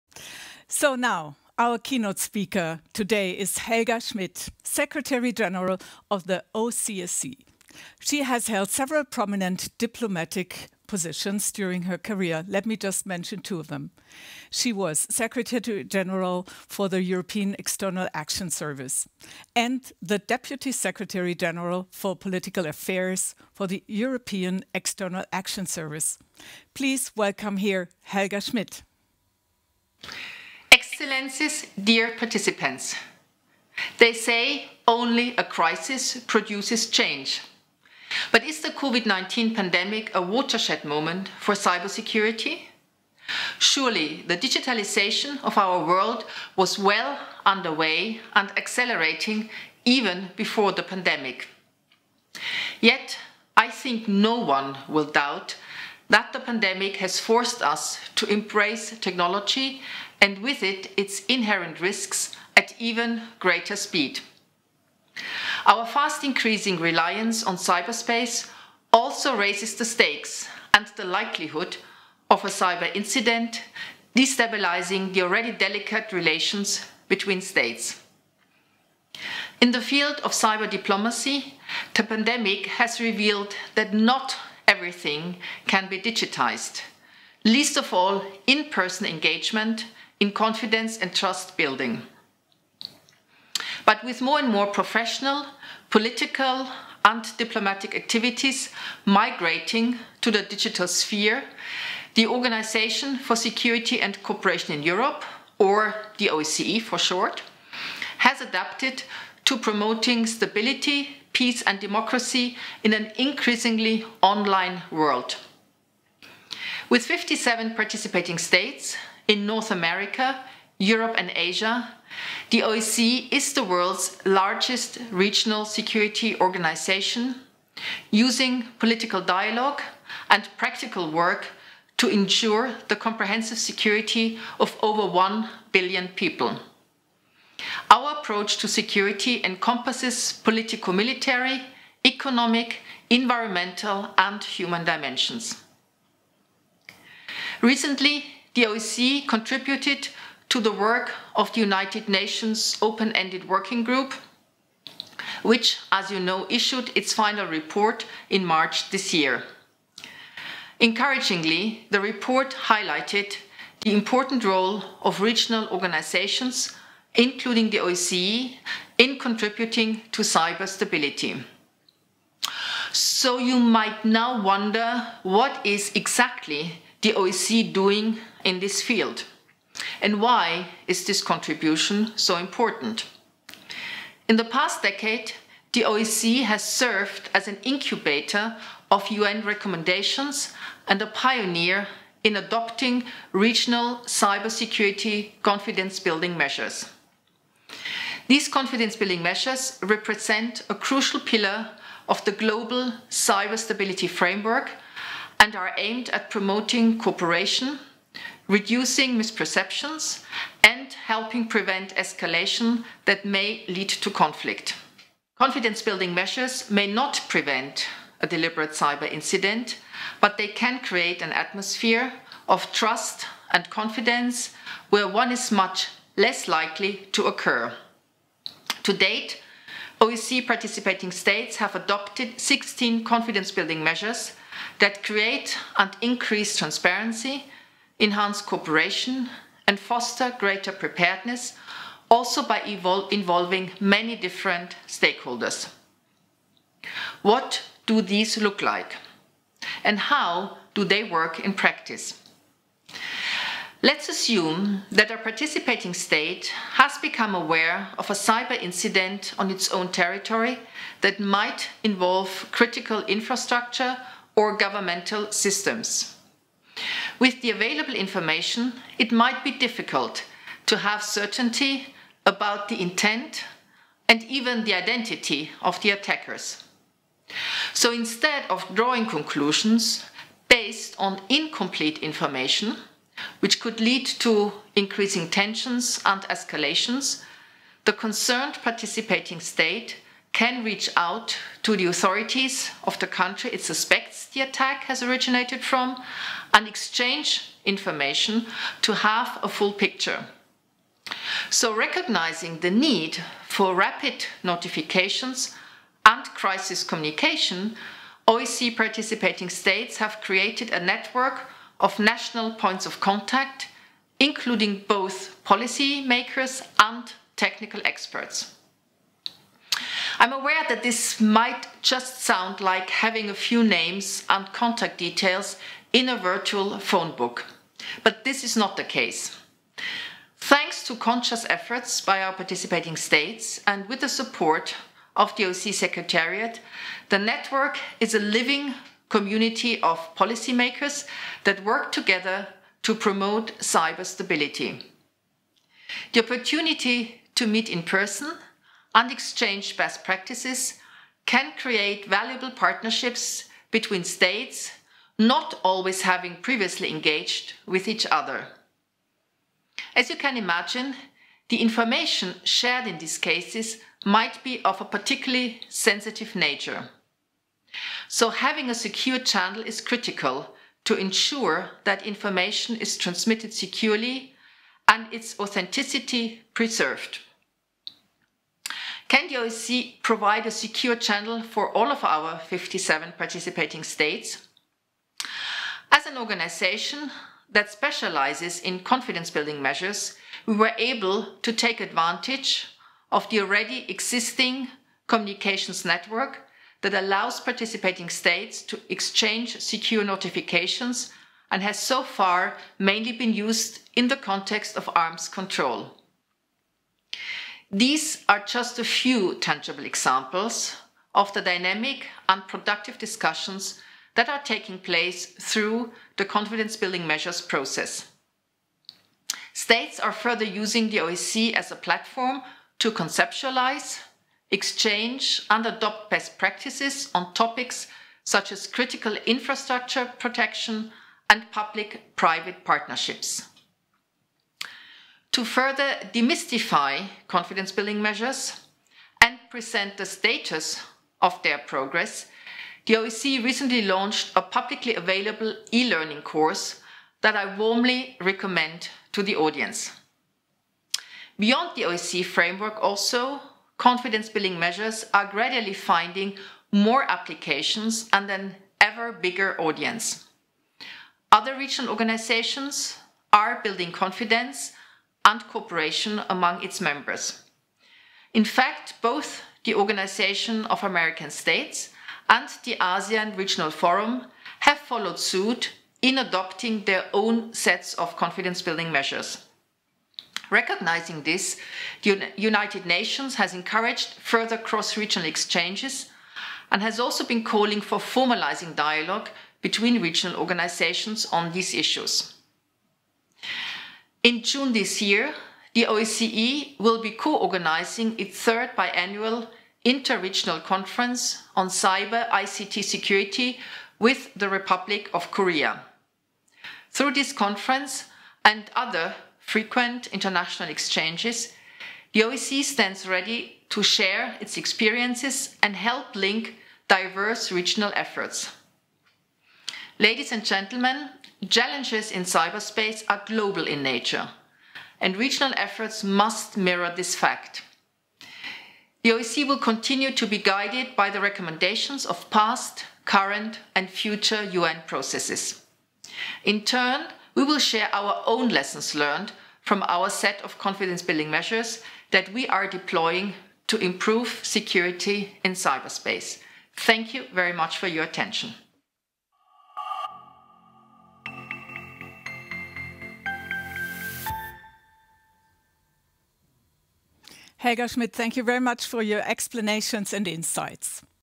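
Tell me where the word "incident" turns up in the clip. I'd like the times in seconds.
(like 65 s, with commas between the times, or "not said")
72 s, 219 s, 258 s.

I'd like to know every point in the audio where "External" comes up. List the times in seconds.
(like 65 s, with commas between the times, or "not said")
17 s, 24 s.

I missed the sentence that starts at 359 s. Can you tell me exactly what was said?
As you can imagine, the information shared in these cases might be of a particularly sensitive nature.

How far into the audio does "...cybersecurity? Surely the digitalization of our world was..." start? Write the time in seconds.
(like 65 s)
41 s.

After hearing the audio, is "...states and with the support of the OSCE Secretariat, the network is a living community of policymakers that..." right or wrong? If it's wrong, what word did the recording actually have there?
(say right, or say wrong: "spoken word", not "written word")
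right.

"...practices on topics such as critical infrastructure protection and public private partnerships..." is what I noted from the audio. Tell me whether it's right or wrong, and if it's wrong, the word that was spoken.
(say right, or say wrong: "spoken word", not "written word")
right.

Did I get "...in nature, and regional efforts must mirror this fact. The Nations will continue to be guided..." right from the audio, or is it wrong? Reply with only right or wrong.
wrong.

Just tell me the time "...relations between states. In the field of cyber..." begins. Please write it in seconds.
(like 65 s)
76 s.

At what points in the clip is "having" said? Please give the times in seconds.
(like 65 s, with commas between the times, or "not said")
322 s, 356 s, 368 s.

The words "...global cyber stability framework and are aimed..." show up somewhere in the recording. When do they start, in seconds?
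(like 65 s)
202 s.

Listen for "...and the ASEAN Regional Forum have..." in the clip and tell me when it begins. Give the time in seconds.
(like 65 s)
472 s.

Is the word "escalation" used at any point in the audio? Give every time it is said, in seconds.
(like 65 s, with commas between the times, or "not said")
211 s, 286 s.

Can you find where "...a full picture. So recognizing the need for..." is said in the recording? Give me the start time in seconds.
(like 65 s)
299 s.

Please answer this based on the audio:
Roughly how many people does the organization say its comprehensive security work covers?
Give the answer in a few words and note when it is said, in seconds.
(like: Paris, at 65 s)
Over 1 billion, at 134 s.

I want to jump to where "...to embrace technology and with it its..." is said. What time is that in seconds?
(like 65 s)
58 s.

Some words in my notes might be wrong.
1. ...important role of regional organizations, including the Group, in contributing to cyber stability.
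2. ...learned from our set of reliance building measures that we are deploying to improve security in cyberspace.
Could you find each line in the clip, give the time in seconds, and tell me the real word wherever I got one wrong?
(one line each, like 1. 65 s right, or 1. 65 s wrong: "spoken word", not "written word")
1. 163 s wrong: "OSCE", not "Group"
2. 538 s wrong: "confidence", not "reliance".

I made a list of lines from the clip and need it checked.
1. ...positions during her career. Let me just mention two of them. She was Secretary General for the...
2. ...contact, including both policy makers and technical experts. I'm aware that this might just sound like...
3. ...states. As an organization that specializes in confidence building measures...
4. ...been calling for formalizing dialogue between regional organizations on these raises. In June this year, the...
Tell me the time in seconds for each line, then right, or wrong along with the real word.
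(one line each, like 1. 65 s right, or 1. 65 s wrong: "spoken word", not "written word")
1. 10 s right
2. 312 s right
3. 383 s right
4. 487 s wrong: "issues", not "raises".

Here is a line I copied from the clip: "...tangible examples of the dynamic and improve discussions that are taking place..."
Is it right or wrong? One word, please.
wrong.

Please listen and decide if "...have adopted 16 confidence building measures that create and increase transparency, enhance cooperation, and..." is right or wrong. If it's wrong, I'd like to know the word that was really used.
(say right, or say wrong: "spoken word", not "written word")
right.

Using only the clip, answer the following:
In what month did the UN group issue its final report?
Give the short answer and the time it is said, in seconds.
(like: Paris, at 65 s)
March, at 158 s.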